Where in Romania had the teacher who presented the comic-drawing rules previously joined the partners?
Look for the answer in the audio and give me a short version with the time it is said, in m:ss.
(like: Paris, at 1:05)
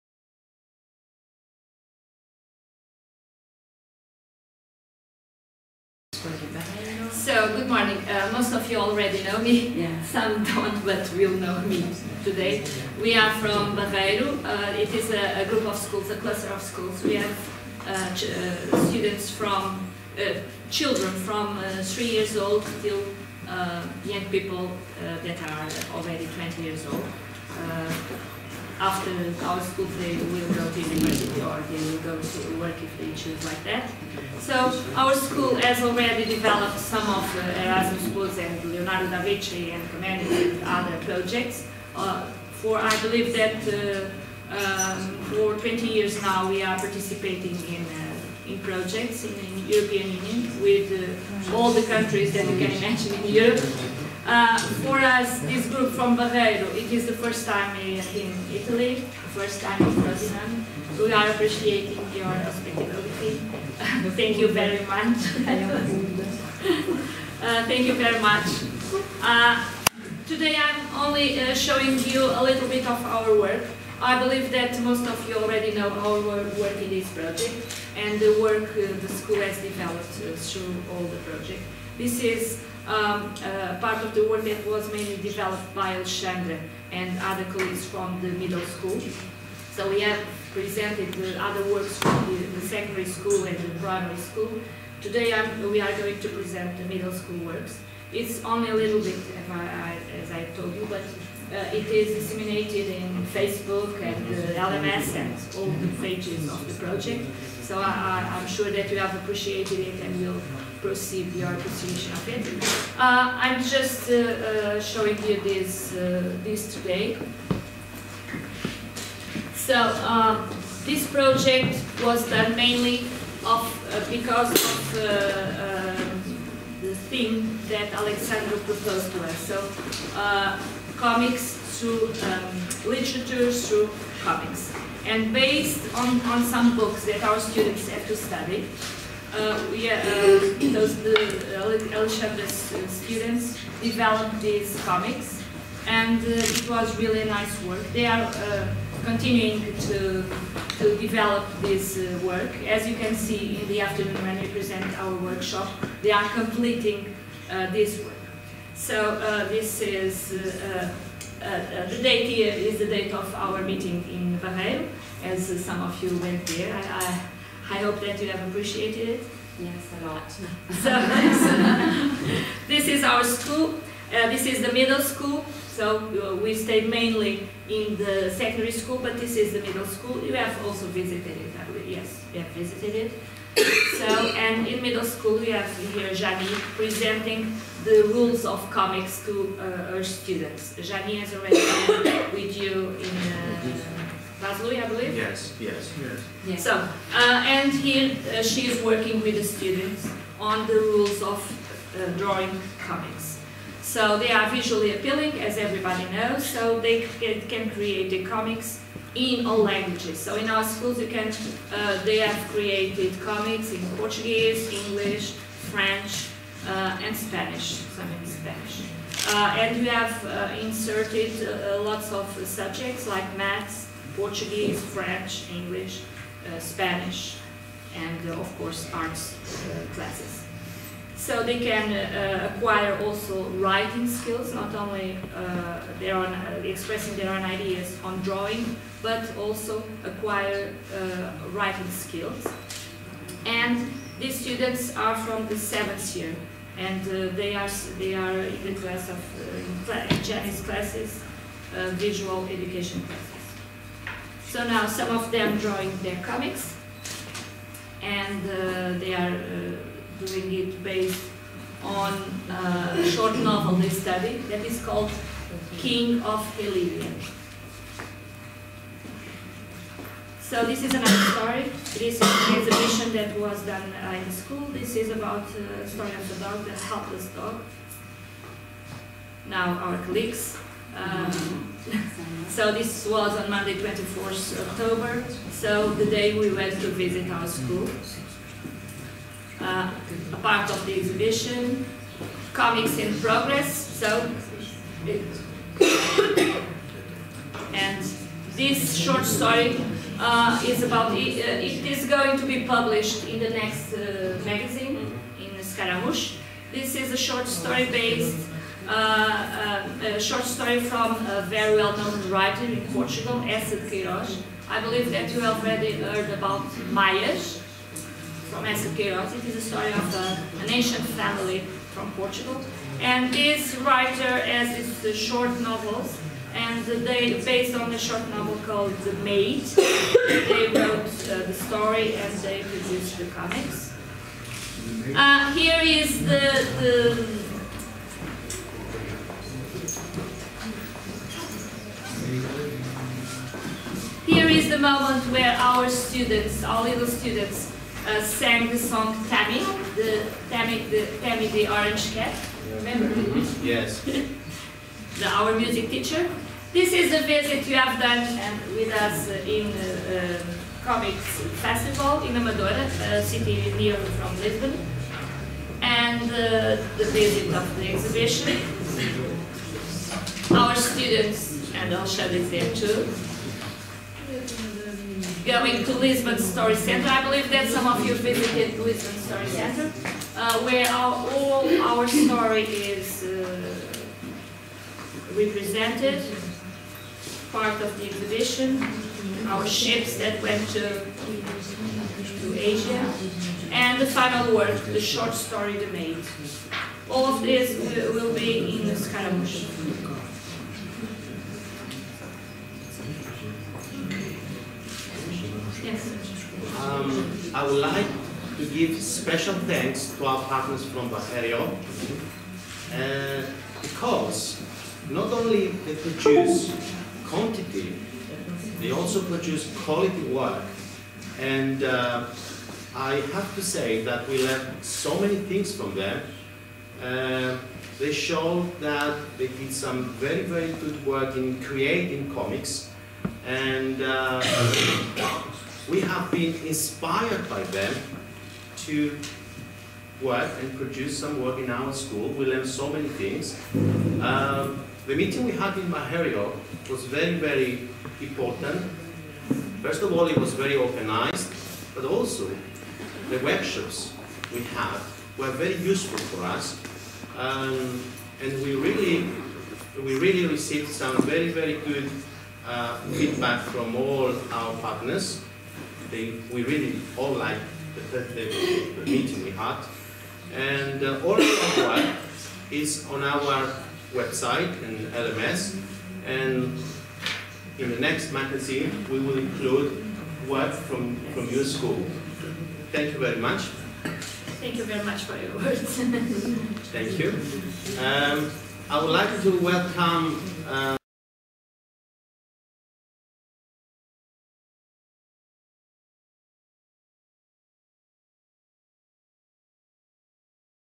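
Vaslui, at 3:14.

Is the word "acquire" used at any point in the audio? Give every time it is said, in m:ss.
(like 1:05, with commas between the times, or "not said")
3:52, 4:00.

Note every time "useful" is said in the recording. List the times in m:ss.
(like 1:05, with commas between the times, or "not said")
7:35.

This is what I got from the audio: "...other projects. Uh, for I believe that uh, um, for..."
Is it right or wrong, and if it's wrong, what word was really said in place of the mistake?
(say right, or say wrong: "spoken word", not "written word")
right.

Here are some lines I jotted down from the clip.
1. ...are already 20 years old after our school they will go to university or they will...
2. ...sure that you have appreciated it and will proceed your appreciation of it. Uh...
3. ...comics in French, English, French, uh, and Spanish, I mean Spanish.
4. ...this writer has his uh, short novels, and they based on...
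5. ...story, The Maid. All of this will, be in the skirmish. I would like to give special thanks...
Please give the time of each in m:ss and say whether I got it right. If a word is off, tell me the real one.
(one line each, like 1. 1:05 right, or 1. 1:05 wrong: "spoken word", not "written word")
1. 0:25 right
2. 1:48 right
3. 3:33 wrong: "Portuguese", not "French"
4. 5:23 right
5. 6:35 right.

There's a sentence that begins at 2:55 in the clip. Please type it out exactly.
So uh, we stayed mainly in the secondary school, but this is the middle school.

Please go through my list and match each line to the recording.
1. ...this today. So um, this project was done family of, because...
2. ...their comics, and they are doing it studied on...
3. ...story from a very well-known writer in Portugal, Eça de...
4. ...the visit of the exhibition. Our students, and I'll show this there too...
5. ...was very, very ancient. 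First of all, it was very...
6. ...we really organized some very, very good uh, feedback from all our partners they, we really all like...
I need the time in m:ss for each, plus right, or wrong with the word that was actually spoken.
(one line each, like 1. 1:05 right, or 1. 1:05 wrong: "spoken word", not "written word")
1. 1:56 wrong: "mainly", not "family"
2. 4:16 wrong: "based", not "studied"
3. 5:10 right
4. 6:06 right
5. 7:26 wrong: "important", not "ancient"
6. 7:40 wrong: "received", not "organized".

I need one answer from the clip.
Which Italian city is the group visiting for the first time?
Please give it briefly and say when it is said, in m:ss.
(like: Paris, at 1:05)
Frosinone, at 0:59.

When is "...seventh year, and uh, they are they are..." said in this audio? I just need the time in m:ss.
4:05.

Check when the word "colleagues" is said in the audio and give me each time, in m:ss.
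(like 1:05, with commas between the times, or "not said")
1:27, 4:39.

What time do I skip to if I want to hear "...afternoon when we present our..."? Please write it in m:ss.
2:33.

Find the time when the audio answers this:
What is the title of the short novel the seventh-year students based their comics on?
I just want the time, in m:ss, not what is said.
4:25.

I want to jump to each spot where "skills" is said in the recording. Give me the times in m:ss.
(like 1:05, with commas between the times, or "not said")
3:54, 4:01.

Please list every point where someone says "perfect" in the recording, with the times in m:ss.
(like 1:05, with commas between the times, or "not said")
not said.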